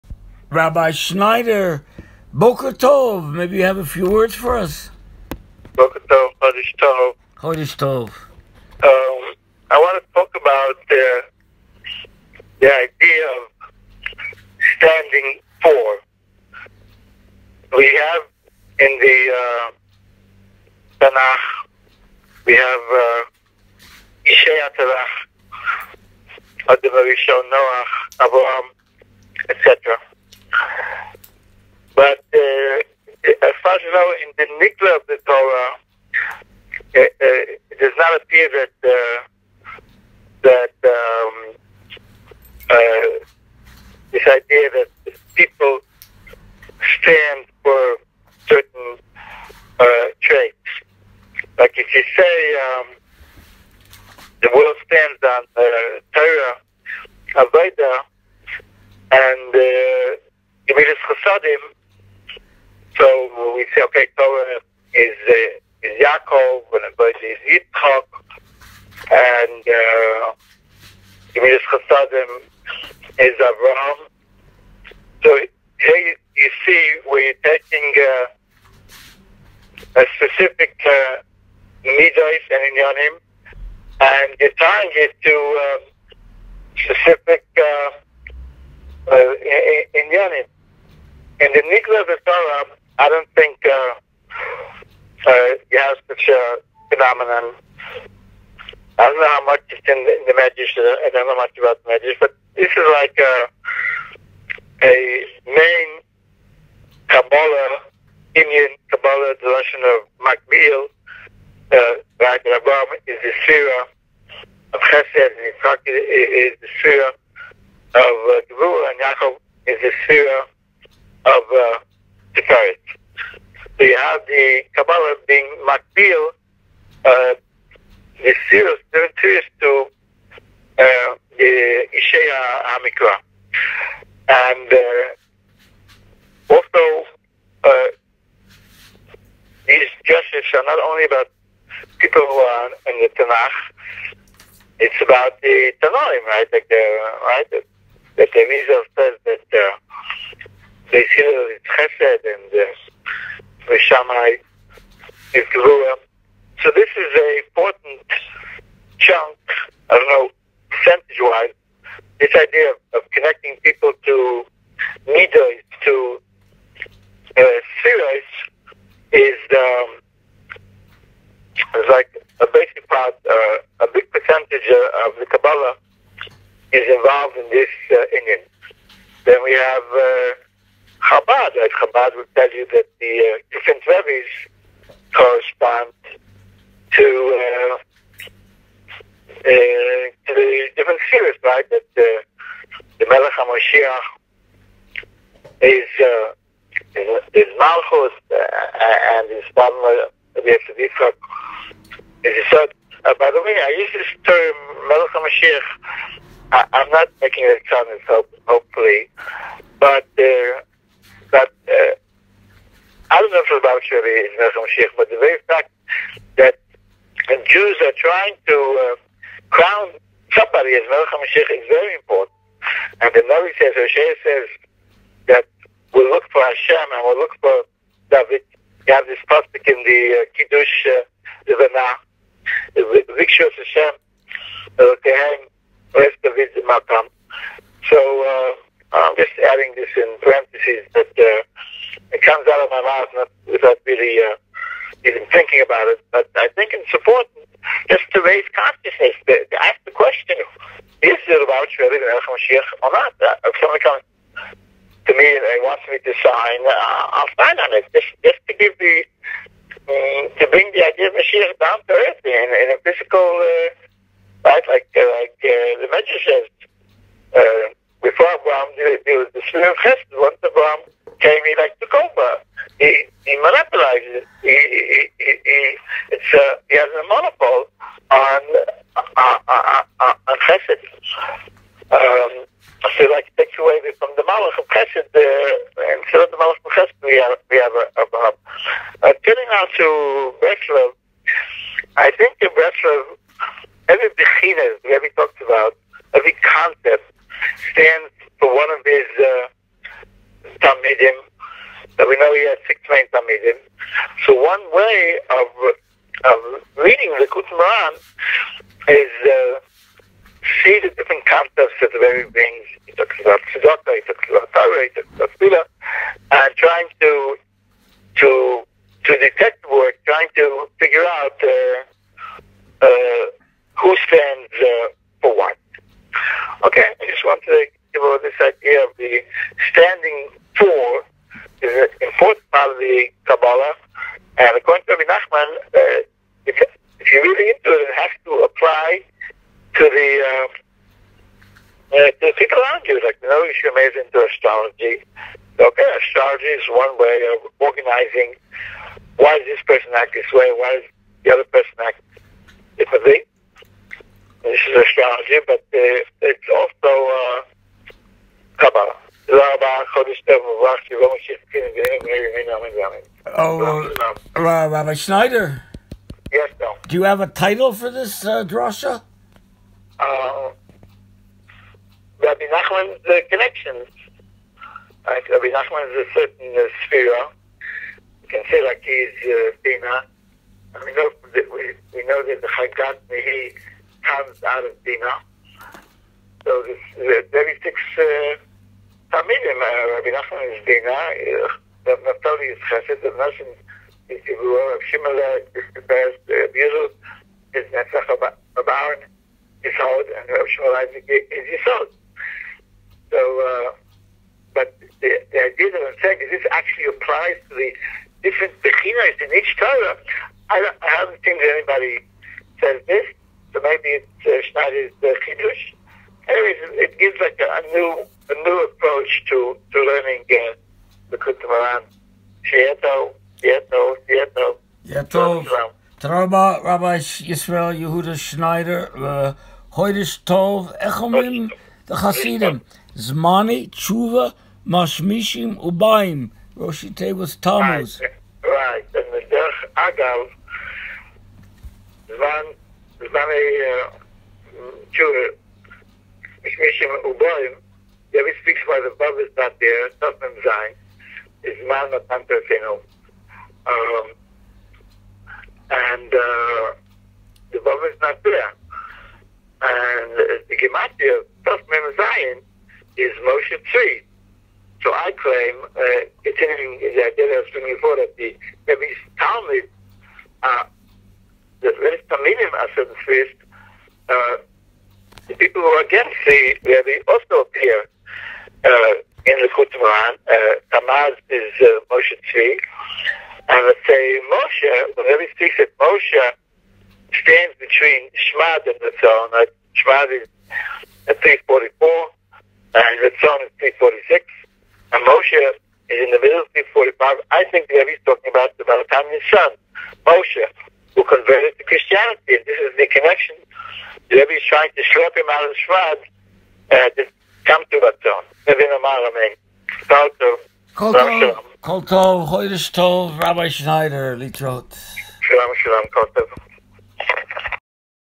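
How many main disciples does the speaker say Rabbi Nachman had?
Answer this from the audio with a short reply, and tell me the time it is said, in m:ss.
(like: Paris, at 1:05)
6, at 5:02.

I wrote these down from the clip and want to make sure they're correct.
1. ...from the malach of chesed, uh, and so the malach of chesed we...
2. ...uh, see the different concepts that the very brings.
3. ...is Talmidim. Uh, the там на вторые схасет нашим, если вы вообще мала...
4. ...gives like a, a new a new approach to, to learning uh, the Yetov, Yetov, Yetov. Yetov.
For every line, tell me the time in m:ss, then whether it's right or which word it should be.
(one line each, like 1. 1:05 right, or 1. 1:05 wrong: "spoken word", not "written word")
1. 4:43 right
2. 5:09 right
3. 6:30 wrong: "Bina", not "Talmidim"
4. 6:56 right.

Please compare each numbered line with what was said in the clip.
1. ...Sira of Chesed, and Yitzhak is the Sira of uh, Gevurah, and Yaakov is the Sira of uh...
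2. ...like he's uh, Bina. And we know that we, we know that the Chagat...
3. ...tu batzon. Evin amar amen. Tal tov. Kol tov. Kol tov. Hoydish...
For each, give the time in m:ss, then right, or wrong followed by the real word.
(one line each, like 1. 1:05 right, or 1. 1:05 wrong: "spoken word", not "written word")
1. 1:53 right
2. 6:18 right
3. 8:27 right.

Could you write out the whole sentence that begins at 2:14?
And uh, also, uh, these justices are not only about people who are in the Tanakh, it's about the Tanoim, right?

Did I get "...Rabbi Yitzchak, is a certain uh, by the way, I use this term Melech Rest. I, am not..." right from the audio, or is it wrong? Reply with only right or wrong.
wrong.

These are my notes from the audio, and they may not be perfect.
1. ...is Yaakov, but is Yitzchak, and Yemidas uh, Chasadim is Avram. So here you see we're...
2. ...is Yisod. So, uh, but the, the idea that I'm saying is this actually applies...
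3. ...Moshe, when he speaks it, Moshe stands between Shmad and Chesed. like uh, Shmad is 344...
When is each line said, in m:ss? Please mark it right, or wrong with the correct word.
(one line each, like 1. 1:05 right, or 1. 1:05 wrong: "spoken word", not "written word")
1. 1:05 right
2. 6:40 right
3. 8:04 wrong: "Ratzon", not "Chesed".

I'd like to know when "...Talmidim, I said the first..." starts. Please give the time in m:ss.
7:52.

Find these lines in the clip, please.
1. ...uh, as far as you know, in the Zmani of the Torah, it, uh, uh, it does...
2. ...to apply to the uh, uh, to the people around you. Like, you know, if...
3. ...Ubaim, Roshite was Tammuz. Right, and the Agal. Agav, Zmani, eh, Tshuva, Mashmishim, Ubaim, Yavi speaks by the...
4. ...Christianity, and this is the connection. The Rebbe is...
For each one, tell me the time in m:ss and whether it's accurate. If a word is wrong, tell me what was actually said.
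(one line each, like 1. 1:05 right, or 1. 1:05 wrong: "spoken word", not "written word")
1. 0:32 wrong: "Nigla", not "Zmani"
2. 5:38 right
3. 7:15 right
4. 8:21 right.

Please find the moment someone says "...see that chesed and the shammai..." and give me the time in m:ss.
2:31.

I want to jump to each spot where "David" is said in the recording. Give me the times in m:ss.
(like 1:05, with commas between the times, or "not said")
3:48, 3:56.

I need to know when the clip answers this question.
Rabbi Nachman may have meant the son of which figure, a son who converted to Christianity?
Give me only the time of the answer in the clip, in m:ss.
8:18.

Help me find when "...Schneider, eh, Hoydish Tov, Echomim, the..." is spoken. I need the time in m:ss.
7:08.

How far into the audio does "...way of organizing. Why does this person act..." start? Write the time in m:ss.
5:46.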